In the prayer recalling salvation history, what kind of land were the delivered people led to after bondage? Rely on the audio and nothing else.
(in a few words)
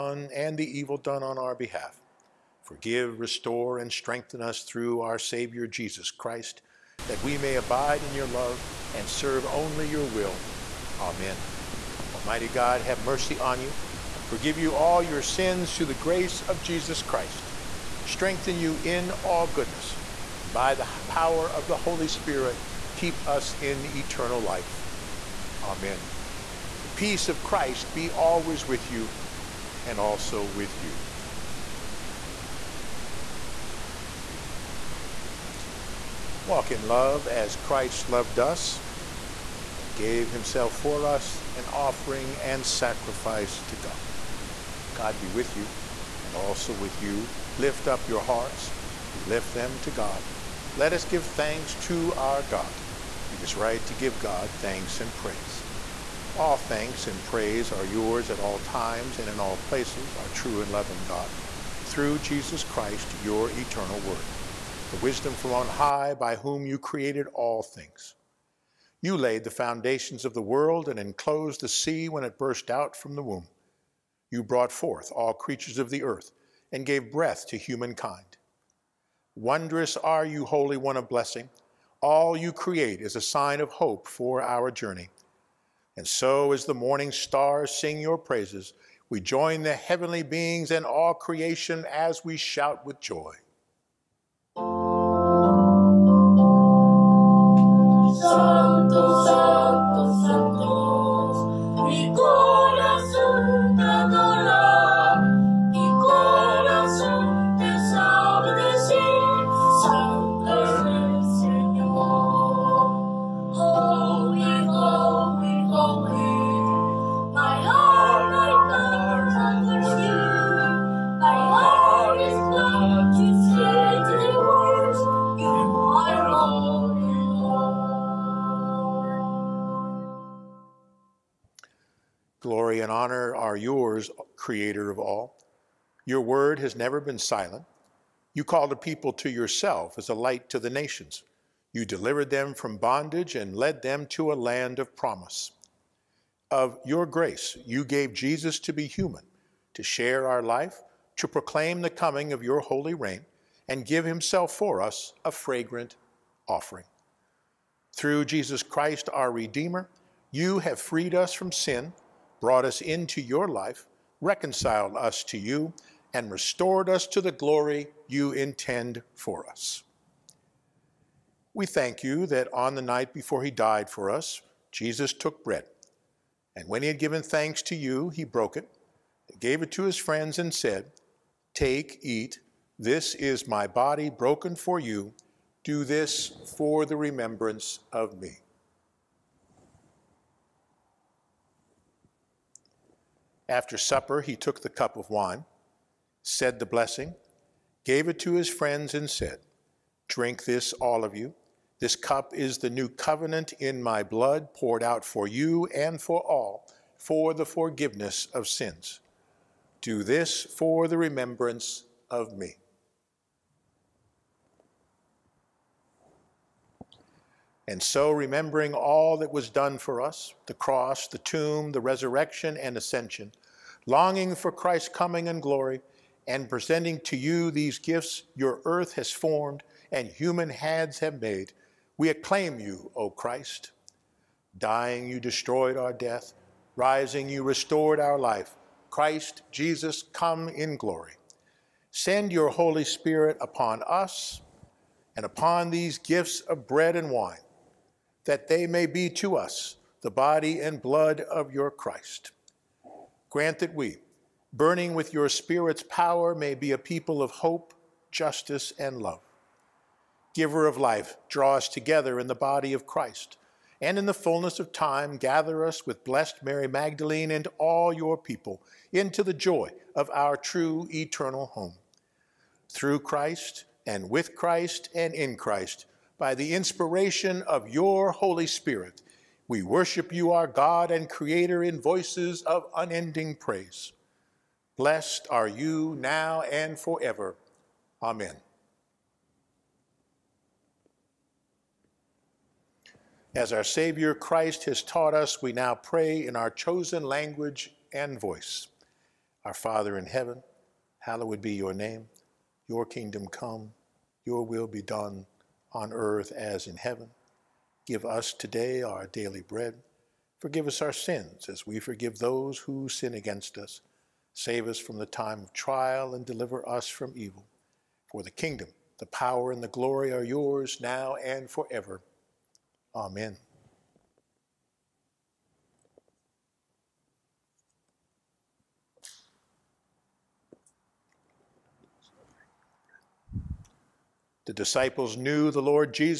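a land of promise.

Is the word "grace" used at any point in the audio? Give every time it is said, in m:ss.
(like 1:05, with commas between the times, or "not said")
0:15, 2:27.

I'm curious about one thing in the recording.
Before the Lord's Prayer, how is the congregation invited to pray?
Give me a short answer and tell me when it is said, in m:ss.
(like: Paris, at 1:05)
chosen language and voice, at 4:56.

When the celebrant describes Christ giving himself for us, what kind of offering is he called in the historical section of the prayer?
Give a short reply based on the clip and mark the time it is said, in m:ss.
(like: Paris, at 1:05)
a fragrant offering, at 2:35.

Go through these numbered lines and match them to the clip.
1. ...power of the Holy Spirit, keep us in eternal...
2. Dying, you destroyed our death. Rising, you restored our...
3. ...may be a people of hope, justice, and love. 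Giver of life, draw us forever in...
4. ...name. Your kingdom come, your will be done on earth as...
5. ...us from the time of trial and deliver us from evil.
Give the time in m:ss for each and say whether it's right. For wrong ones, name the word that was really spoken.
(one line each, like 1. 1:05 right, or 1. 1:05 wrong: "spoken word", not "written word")
1. 0:21 right
2. 3:54 right
3. 4:16 wrong: "together", not "forever"
4. 5:01 right
5. 5:14 right.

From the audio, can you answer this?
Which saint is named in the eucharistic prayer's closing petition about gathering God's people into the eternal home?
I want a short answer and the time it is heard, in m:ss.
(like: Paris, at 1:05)
Mary Magdalene, at 4:26.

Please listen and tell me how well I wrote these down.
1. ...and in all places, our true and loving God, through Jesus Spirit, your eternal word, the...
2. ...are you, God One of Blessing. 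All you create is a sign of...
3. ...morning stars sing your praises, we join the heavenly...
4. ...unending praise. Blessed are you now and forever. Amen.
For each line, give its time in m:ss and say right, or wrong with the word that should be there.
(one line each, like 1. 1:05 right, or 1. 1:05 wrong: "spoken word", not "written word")
1. 0:59 wrong: "Christ", not "Spirit"
2. 1:19 wrong: "Holy", not "God"
3. 1:26 right
4. 4:42 right.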